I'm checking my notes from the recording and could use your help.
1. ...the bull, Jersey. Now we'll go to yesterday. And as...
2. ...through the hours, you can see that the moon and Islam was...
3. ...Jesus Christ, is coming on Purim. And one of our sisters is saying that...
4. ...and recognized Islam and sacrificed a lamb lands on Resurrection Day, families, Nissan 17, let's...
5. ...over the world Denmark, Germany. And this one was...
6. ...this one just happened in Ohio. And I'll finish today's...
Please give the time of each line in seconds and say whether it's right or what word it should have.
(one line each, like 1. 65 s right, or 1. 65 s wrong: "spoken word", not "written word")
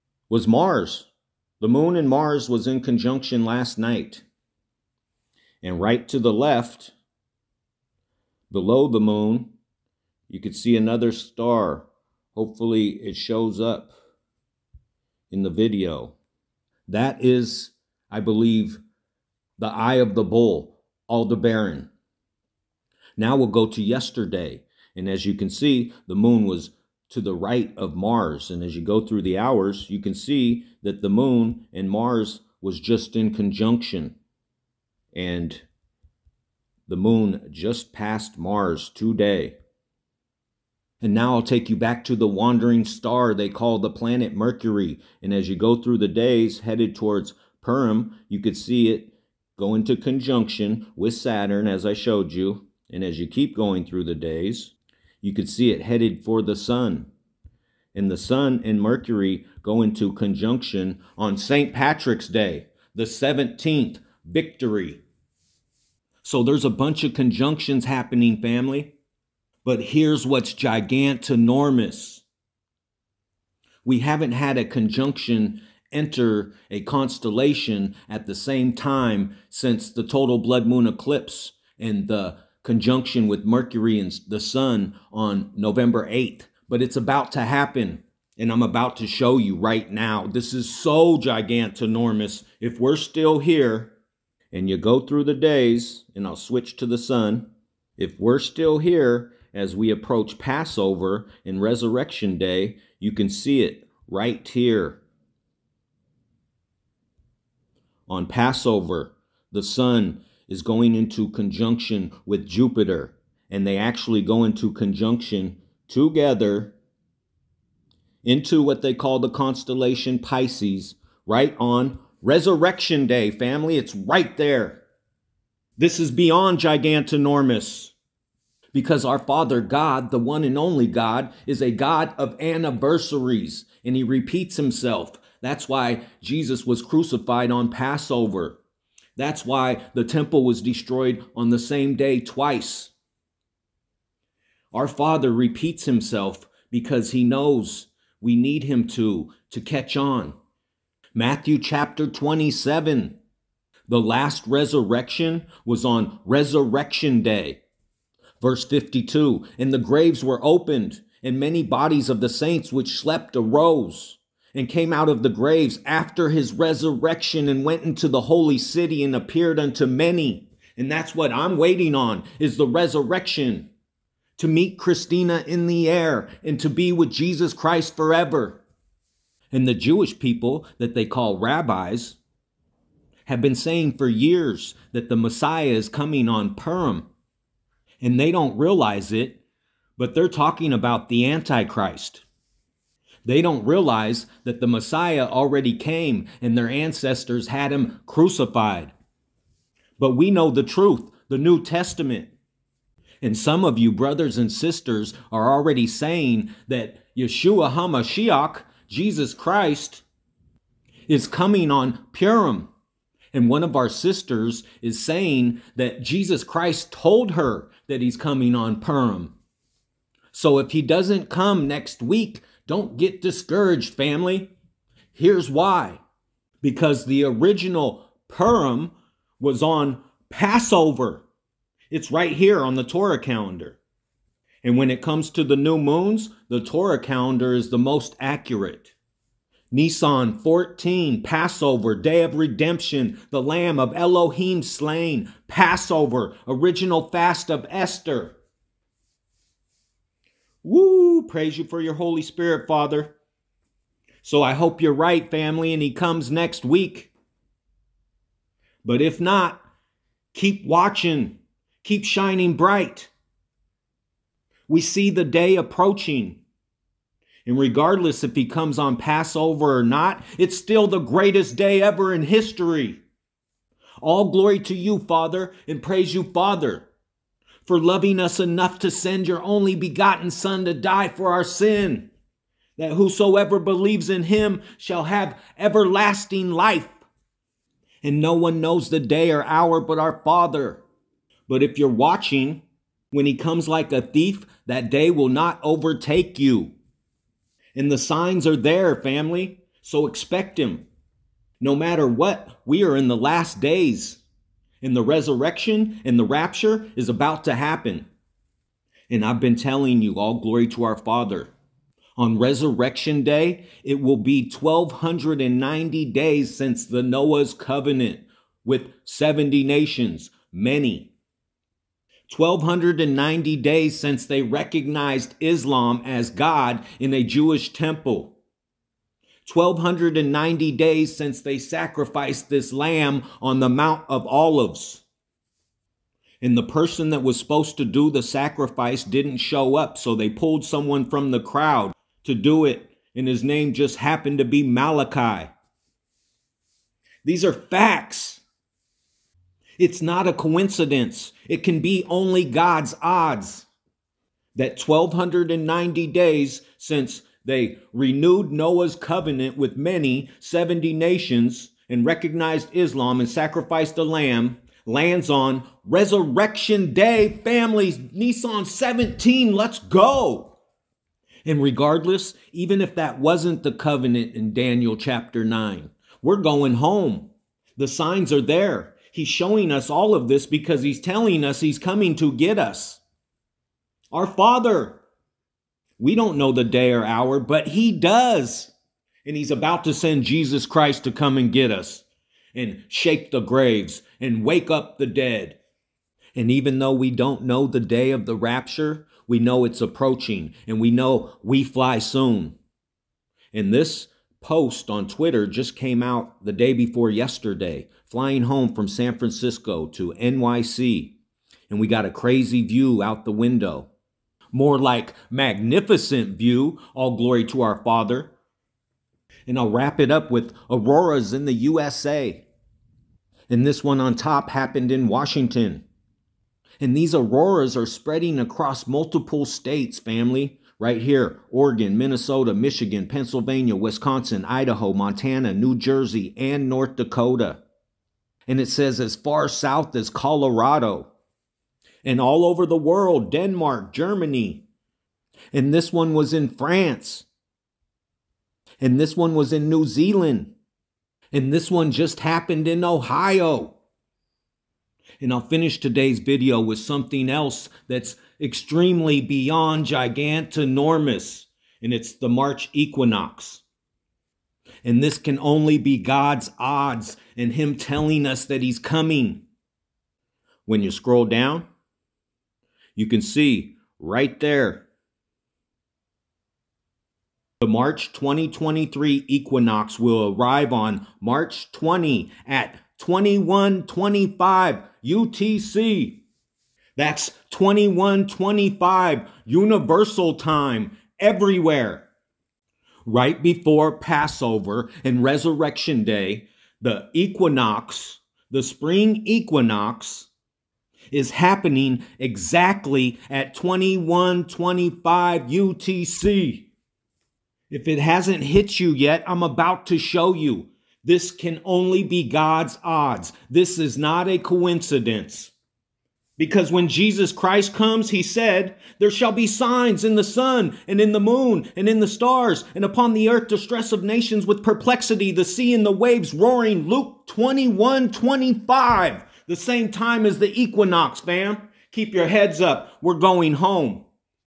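1. 20 s wrong: "Aldebaran", not "Jersey"
2. 29 s wrong: "Mars", not "Islam"
3. 208 s right
4. 361 s right
5. 442 s right
6. 451 s right.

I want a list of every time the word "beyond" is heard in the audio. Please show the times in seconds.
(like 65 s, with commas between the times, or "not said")
126 s, 459 s.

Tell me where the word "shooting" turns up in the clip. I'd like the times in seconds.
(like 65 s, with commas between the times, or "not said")
not said.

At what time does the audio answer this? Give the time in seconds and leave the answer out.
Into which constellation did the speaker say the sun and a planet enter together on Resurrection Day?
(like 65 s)
120 s.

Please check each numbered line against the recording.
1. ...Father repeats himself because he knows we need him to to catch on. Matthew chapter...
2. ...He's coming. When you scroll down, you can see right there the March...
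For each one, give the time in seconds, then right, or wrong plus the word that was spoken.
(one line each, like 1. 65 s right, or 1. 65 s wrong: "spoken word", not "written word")
1. 144 s right
2. 468 s right.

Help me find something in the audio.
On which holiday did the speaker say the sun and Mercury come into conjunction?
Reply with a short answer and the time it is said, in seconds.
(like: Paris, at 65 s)
St. Patrick's Day, at 61 s.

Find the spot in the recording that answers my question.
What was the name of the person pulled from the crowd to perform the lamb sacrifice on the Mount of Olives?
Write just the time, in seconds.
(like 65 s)
344 s.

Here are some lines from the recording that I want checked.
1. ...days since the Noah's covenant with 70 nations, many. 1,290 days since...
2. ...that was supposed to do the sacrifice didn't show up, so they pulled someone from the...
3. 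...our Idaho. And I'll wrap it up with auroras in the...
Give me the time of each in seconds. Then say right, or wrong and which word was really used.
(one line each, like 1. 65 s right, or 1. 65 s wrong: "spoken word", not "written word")
1. 316 s right
2. 337 s right
3. 417 s wrong: "Father", not "Idaho".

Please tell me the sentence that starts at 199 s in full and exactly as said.
But we know the truth, the New Testament.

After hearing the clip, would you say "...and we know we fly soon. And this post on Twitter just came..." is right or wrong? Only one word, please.
right.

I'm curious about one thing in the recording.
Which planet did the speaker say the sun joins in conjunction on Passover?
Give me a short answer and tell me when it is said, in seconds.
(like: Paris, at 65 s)
Jupiter, at 112 s.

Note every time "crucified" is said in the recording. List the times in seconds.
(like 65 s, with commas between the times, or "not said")
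136 s, 198 s.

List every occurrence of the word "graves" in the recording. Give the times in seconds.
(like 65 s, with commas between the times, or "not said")
159 s, 165 s, 393 s.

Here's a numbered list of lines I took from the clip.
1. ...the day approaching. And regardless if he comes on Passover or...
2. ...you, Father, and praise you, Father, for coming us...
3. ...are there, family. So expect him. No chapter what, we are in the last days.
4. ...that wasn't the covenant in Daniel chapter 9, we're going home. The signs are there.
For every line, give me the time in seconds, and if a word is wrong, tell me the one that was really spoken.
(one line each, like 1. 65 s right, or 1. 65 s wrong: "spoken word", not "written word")
1. 265 s right
2. 274 s wrong: "loving", not "coming"
3. 298 s wrong: "matter", not "chapter"
4. 372 s right.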